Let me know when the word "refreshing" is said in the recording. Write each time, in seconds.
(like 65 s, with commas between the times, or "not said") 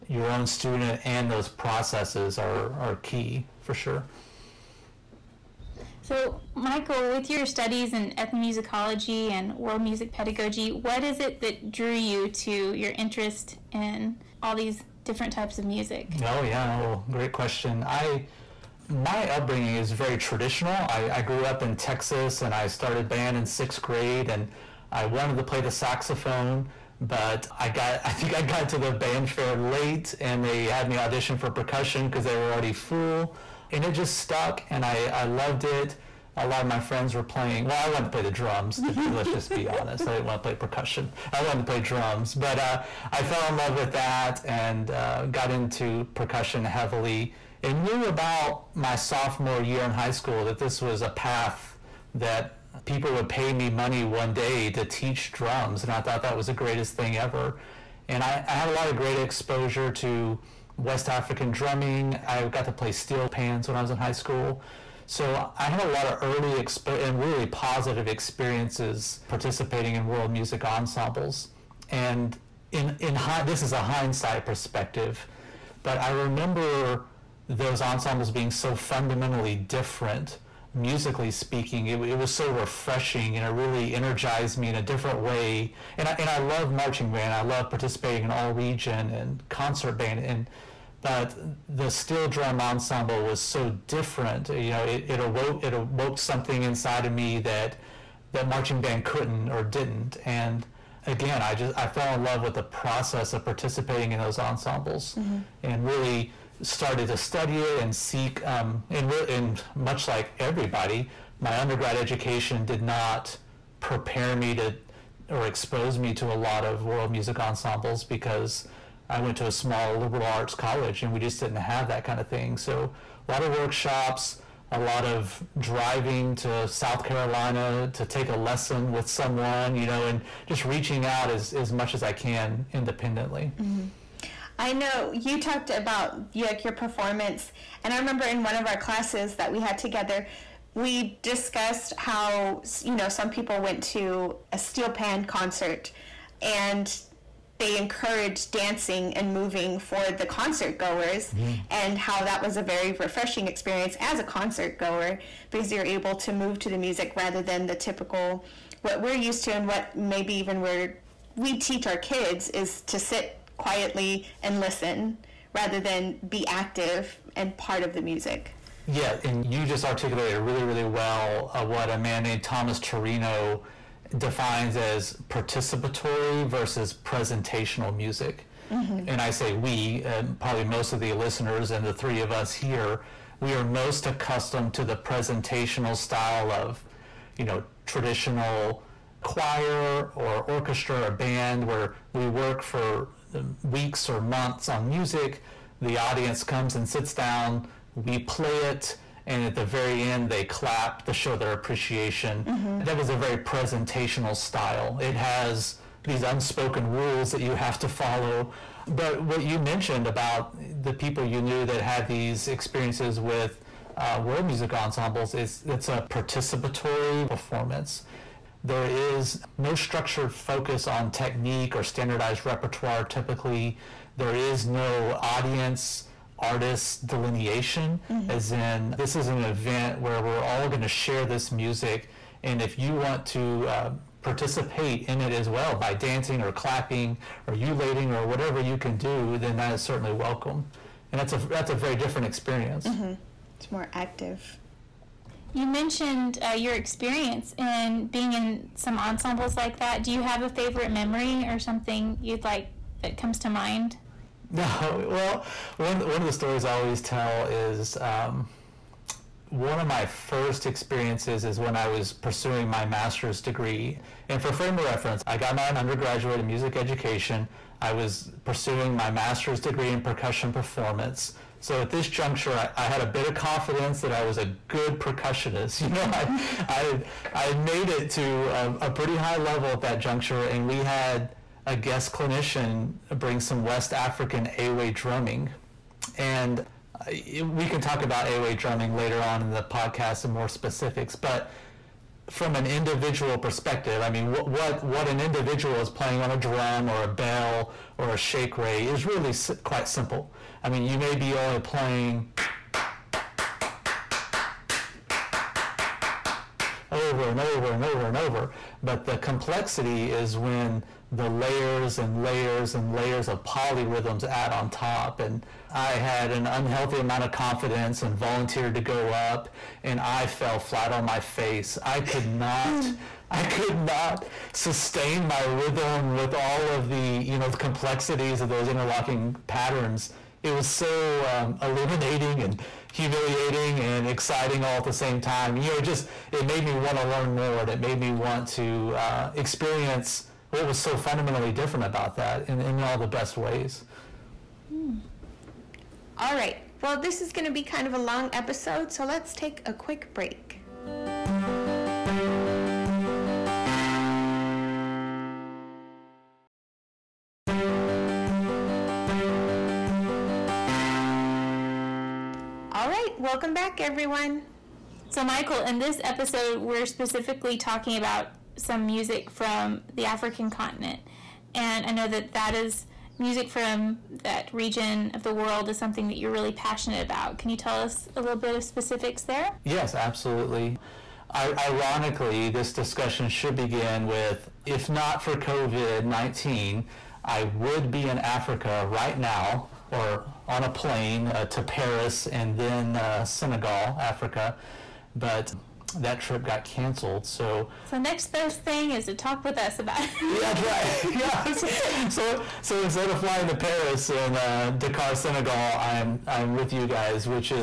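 82 s, 152 s.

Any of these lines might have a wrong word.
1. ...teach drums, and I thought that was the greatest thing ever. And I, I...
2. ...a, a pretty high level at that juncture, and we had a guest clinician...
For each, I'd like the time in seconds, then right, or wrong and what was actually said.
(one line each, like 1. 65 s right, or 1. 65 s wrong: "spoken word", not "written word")
1. 54 s right
2. 278 s right.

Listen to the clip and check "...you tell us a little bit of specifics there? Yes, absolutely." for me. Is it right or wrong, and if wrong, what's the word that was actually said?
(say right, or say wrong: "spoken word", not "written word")
right.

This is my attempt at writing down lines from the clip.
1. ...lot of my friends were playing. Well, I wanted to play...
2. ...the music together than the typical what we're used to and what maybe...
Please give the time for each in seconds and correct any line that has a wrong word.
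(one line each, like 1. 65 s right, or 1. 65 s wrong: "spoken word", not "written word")
1. 36 s right
2. 156 s wrong: "rather", not "together".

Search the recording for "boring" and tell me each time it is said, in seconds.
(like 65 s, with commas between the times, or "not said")
not said.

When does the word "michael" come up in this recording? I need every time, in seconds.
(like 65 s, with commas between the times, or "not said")
6 s, 365 s.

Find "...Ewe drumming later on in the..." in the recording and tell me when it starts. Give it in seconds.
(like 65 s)
288 s.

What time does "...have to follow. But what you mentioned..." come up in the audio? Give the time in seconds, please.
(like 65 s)
207 s.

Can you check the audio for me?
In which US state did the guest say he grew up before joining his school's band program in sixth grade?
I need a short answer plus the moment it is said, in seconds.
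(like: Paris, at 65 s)
Texas, at 21 s.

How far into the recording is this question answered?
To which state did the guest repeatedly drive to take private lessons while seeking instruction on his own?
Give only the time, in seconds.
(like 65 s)
126 s.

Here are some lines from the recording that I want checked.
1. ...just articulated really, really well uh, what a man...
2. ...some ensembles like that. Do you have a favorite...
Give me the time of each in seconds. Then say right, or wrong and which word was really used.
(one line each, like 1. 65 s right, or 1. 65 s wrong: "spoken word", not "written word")
1. 169 s right
2. 248 s right.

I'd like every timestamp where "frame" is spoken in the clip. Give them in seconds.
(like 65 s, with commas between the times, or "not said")
264 s.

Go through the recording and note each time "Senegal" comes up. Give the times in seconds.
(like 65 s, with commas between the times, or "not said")
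393 s, 405 s.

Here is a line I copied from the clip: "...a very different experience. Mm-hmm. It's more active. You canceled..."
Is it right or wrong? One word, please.
wrong.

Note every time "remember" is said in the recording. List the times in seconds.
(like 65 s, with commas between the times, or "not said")
76 s, 137 s.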